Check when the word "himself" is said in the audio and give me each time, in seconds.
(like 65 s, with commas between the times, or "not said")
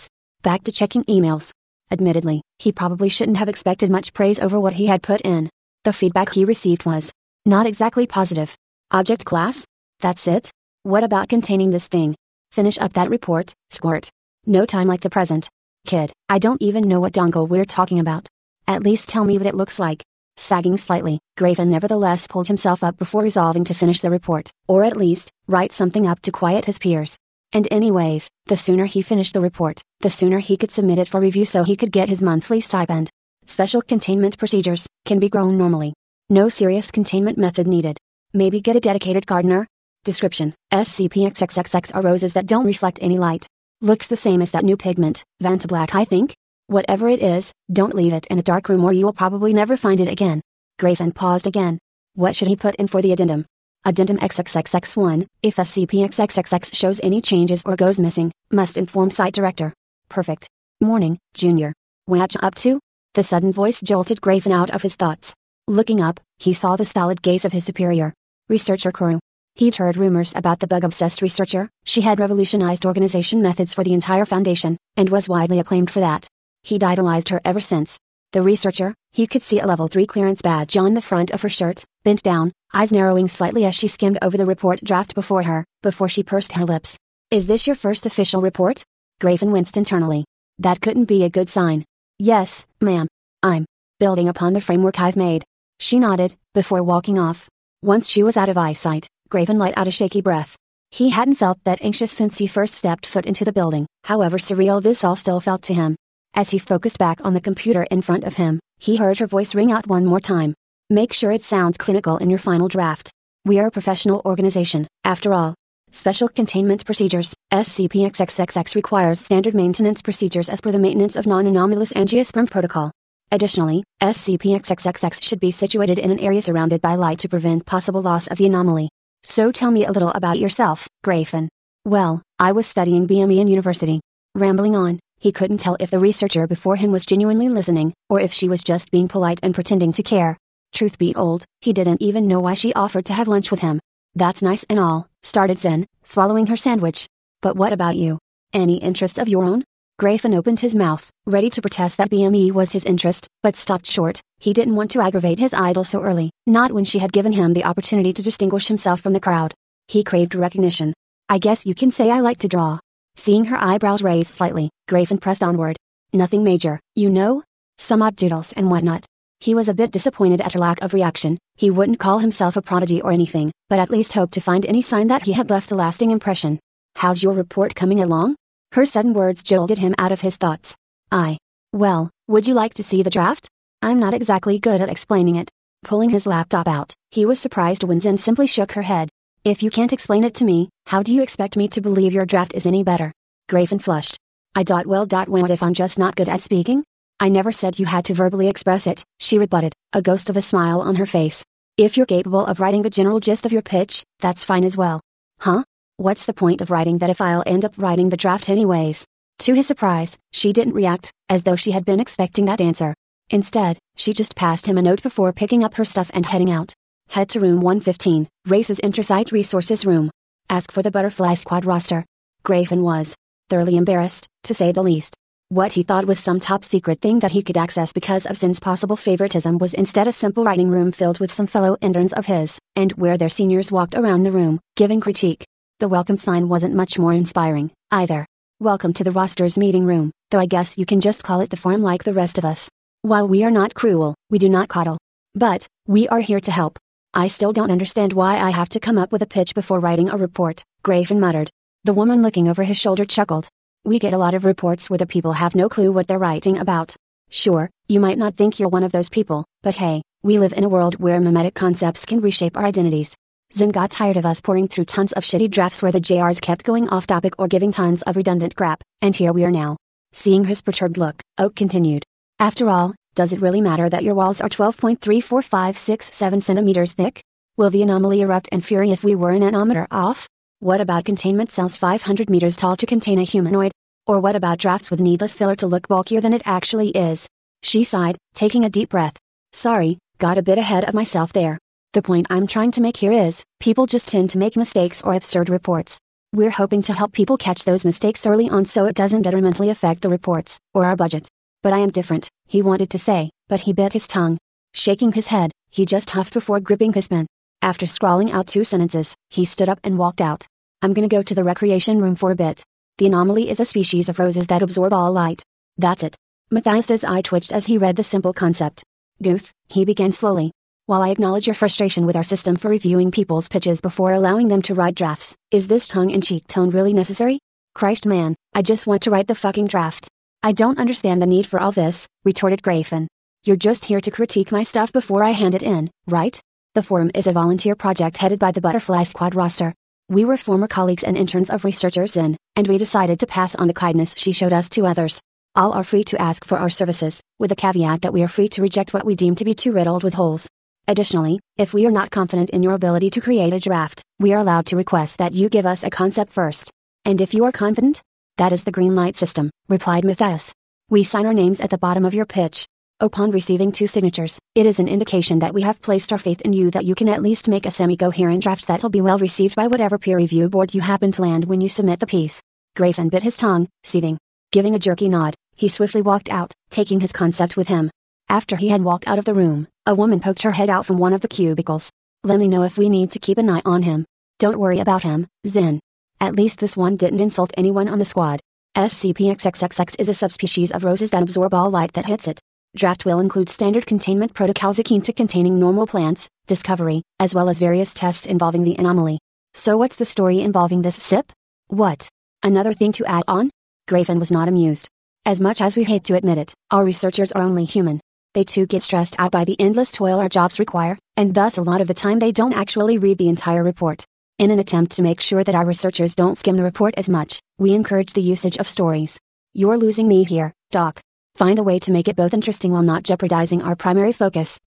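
22 s, 158 s, 172 s.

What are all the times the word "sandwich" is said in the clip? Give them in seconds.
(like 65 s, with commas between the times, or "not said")
146 s.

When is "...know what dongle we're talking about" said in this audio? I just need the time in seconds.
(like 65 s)
16 s.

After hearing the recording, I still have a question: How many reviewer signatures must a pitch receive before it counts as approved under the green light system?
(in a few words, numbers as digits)
2.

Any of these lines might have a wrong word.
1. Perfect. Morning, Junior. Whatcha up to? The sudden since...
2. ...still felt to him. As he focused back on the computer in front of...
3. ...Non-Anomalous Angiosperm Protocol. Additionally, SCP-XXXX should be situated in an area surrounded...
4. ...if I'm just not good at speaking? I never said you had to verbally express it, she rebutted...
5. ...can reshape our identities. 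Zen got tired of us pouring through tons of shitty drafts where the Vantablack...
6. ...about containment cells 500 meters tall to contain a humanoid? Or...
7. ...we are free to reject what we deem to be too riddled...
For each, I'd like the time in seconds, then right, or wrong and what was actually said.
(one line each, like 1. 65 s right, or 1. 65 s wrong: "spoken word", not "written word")
1. 60 s wrong: "voice", not "since"
2. 105 s right
3. 121 s right
4. 195 s right
5. 262 s wrong: "JRs", not "Vantablack"
6. 280 s right
7. 348 s right.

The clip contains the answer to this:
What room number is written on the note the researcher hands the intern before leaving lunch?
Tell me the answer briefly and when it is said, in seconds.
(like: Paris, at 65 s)
115, at 217 s.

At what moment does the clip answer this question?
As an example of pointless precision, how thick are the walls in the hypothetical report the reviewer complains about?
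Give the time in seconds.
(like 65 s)
274 s.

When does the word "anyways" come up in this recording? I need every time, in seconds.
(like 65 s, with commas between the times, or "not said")
27 s, 208 s.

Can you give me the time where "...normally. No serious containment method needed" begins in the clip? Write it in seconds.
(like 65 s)
35 s.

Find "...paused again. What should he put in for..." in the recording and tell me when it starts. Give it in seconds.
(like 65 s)
51 s.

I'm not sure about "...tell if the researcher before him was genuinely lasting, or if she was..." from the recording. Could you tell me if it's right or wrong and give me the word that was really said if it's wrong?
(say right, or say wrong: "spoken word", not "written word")
wrong: "listening", not "lasting".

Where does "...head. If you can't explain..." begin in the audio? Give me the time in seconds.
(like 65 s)
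188 s.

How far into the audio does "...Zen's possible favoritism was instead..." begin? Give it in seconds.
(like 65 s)
228 s.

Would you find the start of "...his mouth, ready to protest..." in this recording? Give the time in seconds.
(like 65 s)
150 s.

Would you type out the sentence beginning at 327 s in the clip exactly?
Christ man, I just want to write the fucking draft.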